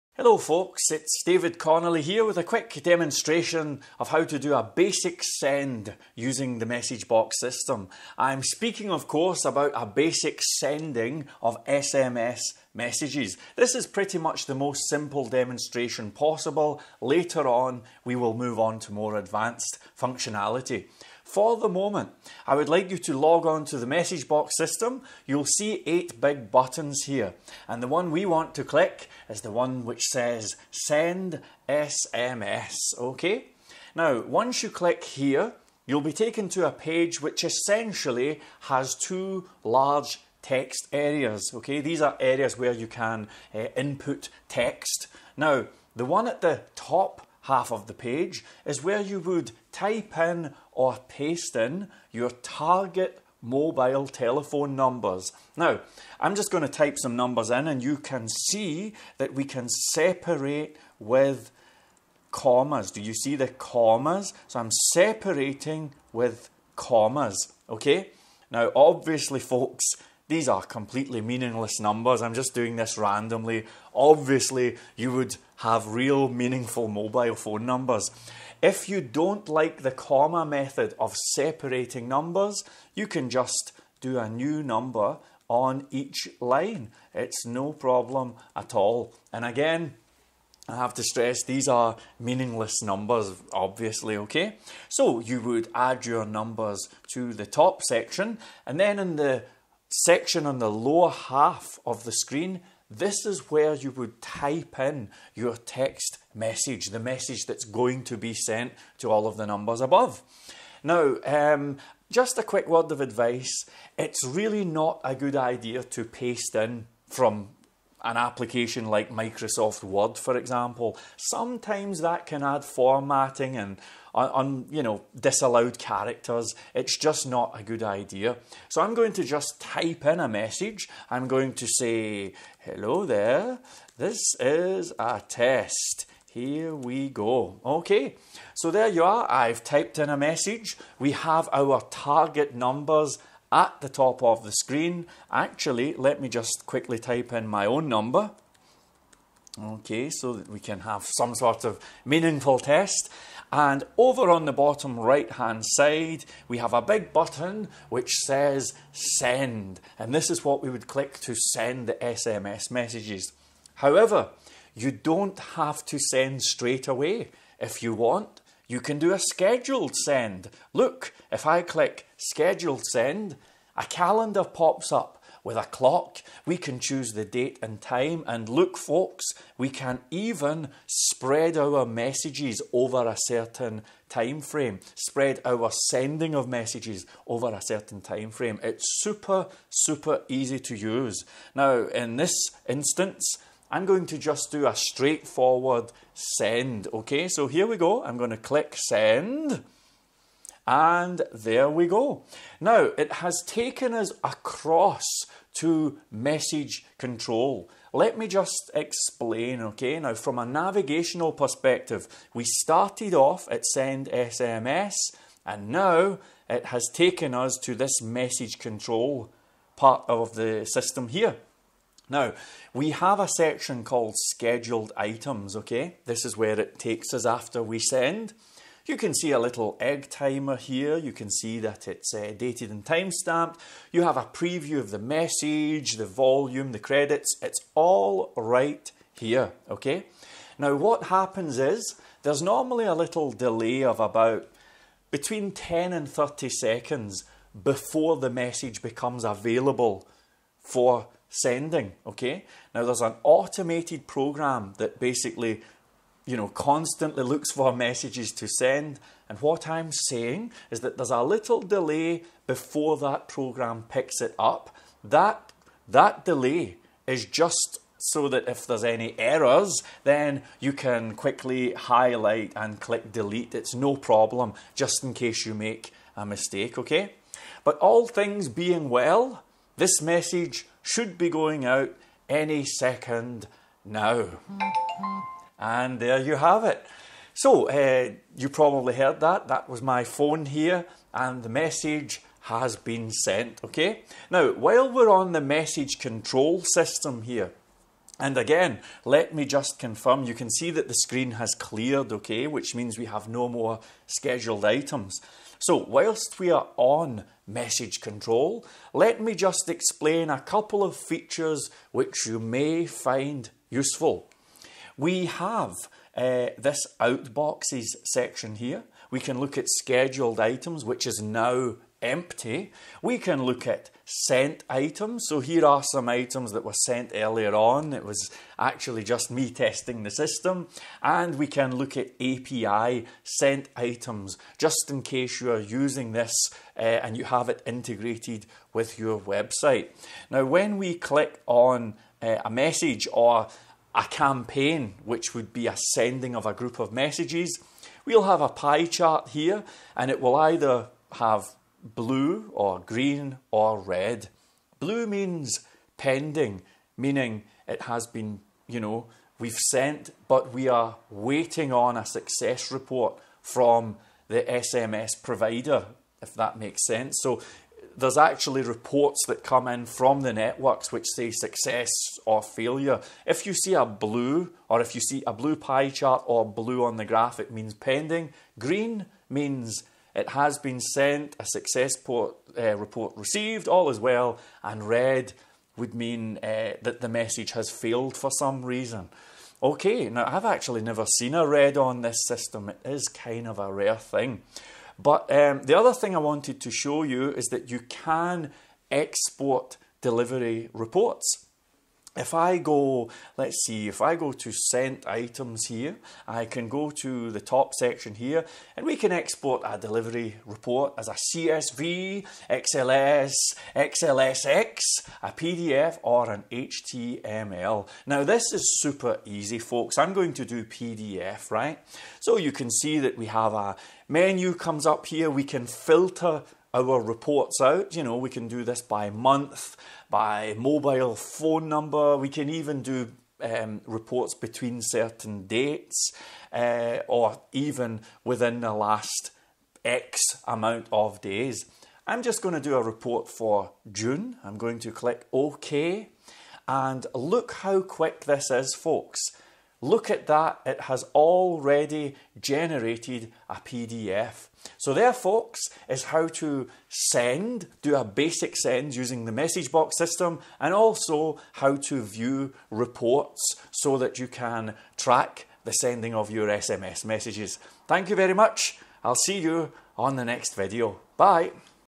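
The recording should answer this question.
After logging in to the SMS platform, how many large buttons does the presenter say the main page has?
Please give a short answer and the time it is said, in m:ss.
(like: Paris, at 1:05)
8, at 0:25.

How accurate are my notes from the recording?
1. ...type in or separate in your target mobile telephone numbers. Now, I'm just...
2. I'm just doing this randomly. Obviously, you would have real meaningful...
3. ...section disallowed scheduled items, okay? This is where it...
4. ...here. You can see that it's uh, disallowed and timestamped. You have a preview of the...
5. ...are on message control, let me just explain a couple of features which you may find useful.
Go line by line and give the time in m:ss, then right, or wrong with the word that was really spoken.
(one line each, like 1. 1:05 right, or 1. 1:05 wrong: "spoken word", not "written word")
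1. 0:49 wrong: "paste", not "separate"
2. 1:12 right
3. 3:43 wrong: "called", not "disallowed"
4. 3:50 wrong: "dated", not "disallowed"
5. 5:06 right.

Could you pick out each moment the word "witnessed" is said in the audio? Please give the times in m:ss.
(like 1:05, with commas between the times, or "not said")
not said.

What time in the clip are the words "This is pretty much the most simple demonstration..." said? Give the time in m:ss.
0:13.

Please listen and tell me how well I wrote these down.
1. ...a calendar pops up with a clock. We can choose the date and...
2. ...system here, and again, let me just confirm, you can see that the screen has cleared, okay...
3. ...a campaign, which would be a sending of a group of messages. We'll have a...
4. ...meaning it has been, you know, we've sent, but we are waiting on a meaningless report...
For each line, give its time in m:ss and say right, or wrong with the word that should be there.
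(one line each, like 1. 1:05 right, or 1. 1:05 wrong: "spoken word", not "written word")
1. 2:53 right
2. 4:56 right
3. 5:43 right
4. 5:56 wrong: "success", not "meaningless".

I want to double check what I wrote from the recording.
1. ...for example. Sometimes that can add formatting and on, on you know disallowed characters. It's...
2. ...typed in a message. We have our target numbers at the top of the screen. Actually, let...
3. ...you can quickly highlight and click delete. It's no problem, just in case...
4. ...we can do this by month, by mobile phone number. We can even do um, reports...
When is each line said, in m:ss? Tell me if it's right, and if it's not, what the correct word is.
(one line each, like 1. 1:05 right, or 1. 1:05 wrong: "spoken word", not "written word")
1. 2:00 right
2. 2:19 right
3. 4:30 right
4. 7:08 right.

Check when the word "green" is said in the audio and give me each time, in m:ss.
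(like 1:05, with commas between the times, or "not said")
5:52, 6:18.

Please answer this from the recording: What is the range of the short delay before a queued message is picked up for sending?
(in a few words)
10 to 30 seconds.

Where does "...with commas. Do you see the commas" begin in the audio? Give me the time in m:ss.
1:00.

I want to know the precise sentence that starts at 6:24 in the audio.
And red would mean uh, that the message has failed for some reason.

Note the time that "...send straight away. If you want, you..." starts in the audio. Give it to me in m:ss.
2:45.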